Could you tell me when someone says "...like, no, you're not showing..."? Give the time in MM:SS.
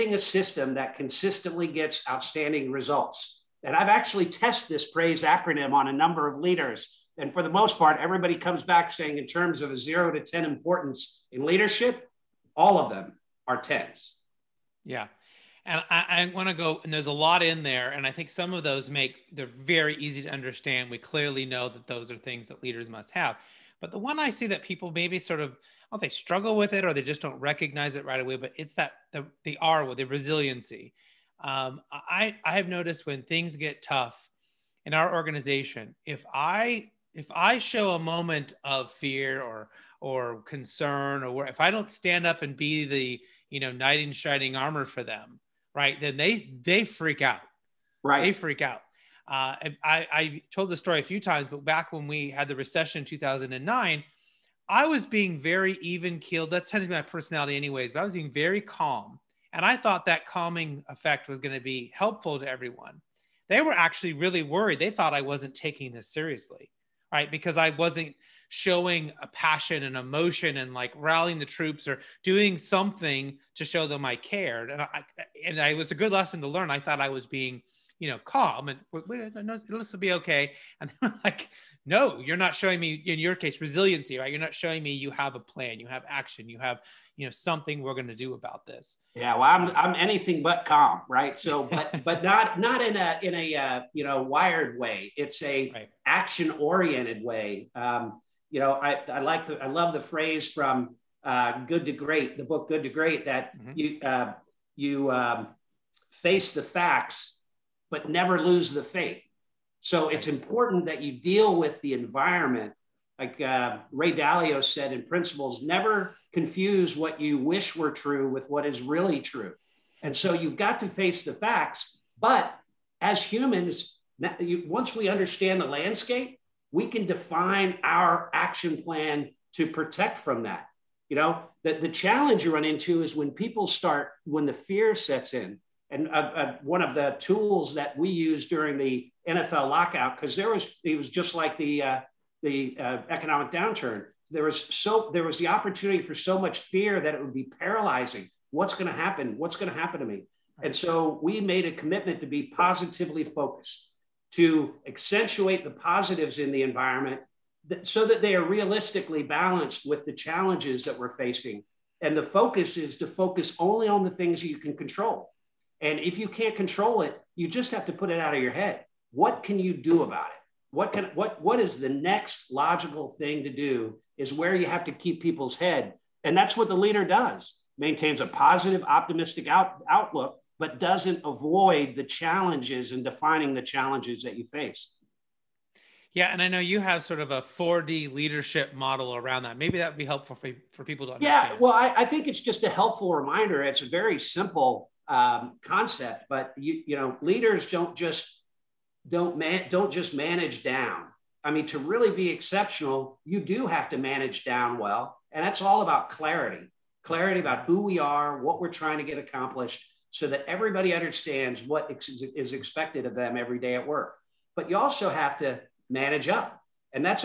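01:21.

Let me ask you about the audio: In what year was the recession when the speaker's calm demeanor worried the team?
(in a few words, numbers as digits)
2009.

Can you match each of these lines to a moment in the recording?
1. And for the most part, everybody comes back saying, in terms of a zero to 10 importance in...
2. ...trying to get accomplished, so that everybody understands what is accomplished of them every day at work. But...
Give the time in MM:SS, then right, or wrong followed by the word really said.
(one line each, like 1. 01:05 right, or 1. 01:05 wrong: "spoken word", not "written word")
1. 00:07 right
2. 03:28 wrong: "expected", not "accomplished".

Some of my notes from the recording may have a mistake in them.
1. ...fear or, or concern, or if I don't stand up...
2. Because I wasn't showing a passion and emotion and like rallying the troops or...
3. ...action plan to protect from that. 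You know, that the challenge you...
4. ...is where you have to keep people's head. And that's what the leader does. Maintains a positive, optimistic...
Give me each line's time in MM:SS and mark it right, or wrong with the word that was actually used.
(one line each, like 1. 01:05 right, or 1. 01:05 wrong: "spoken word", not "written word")
1. 00:38 right
2. 01:07 right
3. 02:08 right
4. 02:54 right.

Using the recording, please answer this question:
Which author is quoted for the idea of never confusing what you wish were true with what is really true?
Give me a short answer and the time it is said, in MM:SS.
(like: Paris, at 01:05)
Ray Dalio, at 01:53.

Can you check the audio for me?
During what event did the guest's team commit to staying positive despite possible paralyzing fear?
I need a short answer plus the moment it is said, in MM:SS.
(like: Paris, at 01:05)
NFL lockout, at 02:19.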